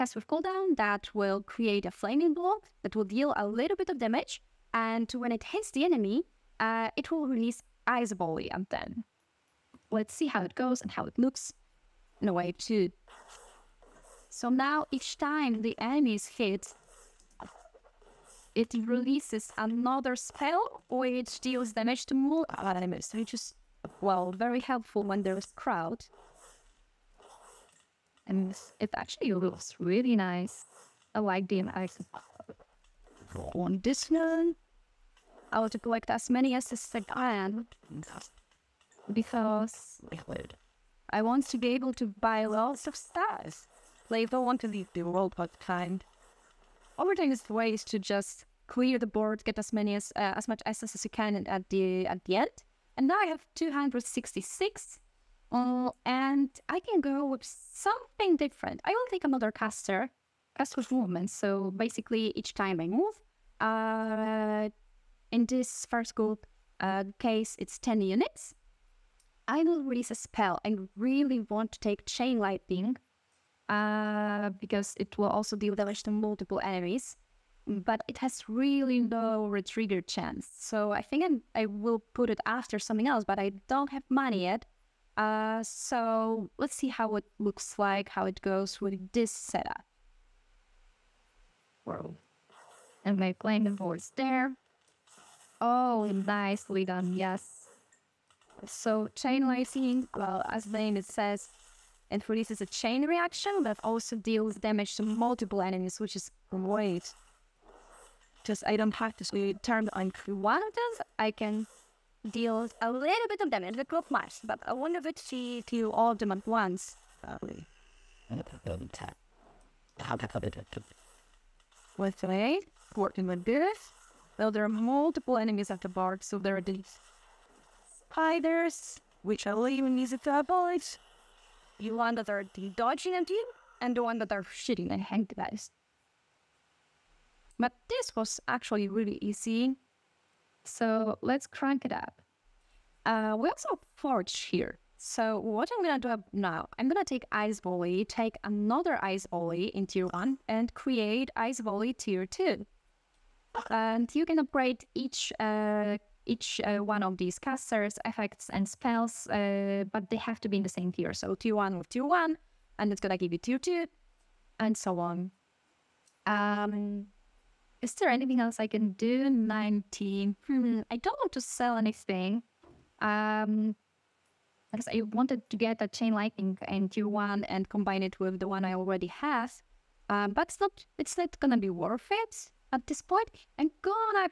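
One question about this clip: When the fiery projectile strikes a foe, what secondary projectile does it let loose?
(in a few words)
Ice Ball.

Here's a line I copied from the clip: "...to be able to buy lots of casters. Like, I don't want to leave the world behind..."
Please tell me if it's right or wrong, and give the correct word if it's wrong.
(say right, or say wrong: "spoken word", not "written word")
wrong: "stars", not "casters".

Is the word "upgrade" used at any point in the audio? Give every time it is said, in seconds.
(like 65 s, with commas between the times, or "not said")
154 s.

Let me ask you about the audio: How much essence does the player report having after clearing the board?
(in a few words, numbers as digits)
266.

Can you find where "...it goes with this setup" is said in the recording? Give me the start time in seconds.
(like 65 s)
88 s.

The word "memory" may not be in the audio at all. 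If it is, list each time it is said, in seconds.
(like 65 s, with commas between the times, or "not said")
not said.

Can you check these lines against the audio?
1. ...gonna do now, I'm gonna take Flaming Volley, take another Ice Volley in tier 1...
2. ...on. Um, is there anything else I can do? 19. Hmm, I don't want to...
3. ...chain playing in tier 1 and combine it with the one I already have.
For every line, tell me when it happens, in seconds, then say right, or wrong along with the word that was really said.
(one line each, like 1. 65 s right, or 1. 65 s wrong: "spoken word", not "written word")
1. 145 s wrong: "Ice", not "Flaming"
2. 164 s right
3. 175 s wrong: "lightning", not "playing".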